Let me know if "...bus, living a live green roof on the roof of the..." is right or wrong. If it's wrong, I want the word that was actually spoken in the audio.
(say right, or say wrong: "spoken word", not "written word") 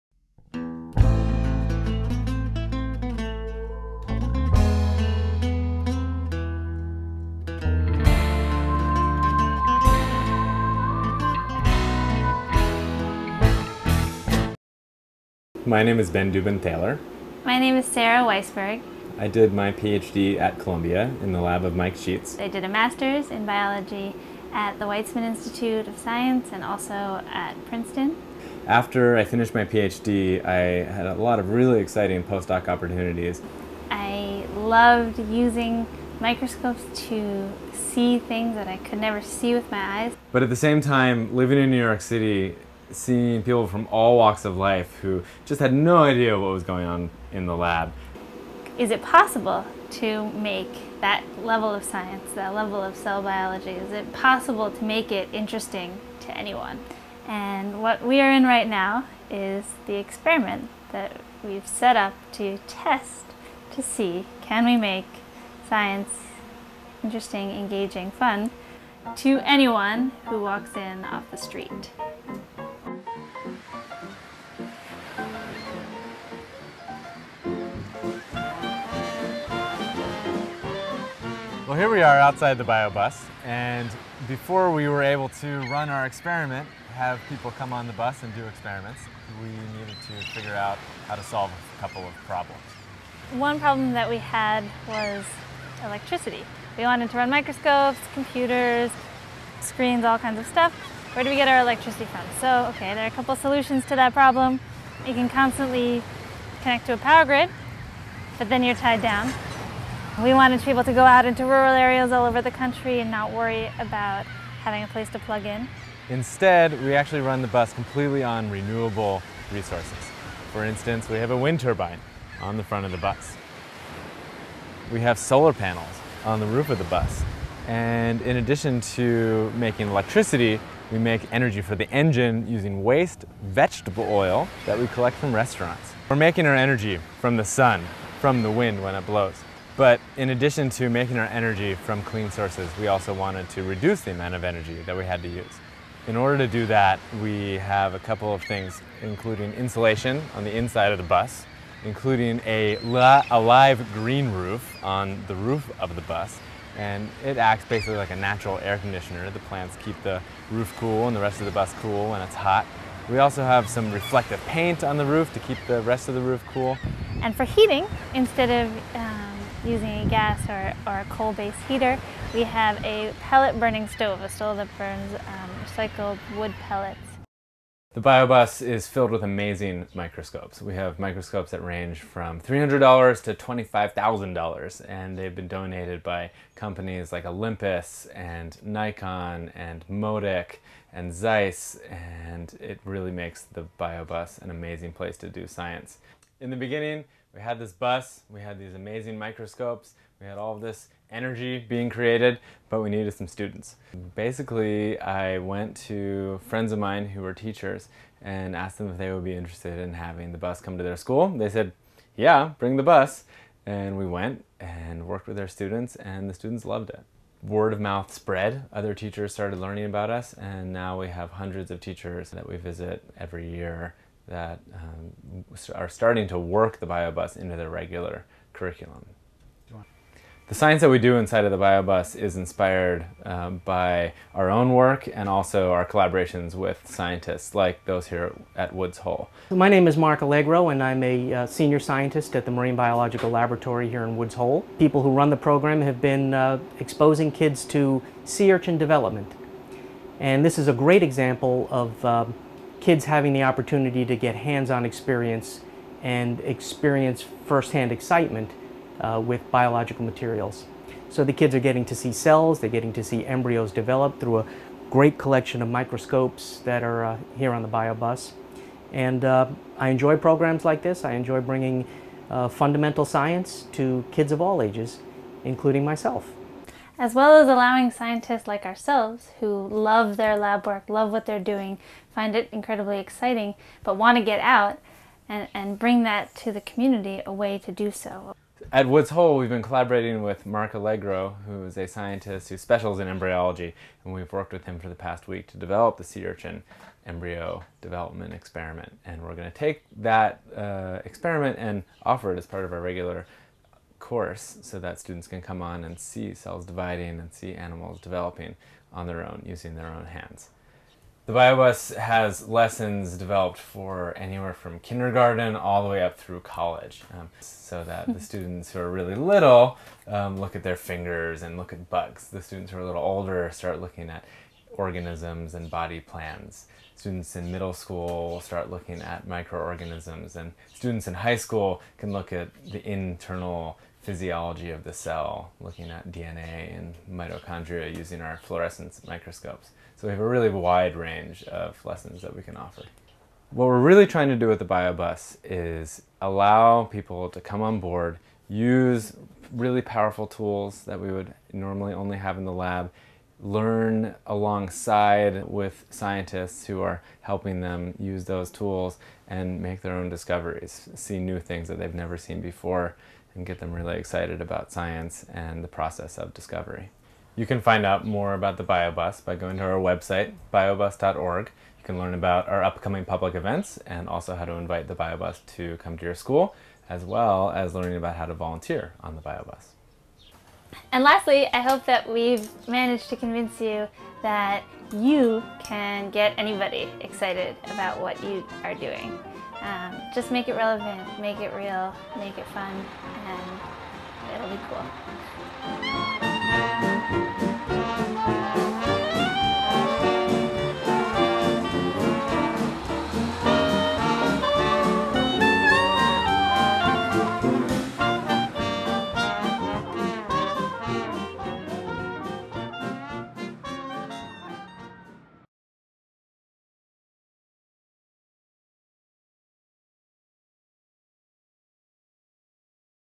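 wrong: "including", not "living".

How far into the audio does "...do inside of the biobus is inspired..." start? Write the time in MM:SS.
03:50.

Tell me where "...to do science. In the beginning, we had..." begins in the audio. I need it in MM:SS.
03:15.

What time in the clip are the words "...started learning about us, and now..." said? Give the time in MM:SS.
03:39.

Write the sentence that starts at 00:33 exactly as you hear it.
I loved using microscopes to see things that I could never see with my eyes.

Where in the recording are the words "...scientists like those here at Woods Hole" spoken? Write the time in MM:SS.
03:56.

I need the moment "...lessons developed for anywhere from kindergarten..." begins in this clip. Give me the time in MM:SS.
05:12.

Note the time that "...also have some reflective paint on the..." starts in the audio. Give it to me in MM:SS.
02:43.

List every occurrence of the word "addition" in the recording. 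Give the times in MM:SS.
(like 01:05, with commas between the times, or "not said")
02:08, 02:20.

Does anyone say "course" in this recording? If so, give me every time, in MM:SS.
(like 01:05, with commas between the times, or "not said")
05:04.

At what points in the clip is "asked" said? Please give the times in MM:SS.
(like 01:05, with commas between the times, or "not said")
03:28.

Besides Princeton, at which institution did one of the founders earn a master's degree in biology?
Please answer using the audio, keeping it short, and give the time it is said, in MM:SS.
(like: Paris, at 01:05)
Weizmann Institute of Science, at 00:24.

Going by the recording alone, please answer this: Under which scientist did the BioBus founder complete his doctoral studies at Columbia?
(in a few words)
Mike Sheetz.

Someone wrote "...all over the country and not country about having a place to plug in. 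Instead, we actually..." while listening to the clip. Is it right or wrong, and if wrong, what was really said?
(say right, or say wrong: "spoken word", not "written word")
wrong: "worry", not "country".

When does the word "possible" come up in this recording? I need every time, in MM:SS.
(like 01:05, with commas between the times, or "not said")
00:49, 00:54.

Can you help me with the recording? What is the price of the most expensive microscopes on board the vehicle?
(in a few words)
$25,000.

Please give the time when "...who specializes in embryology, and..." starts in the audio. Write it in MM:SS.
04:52.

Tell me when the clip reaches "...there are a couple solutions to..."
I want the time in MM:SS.
01:42.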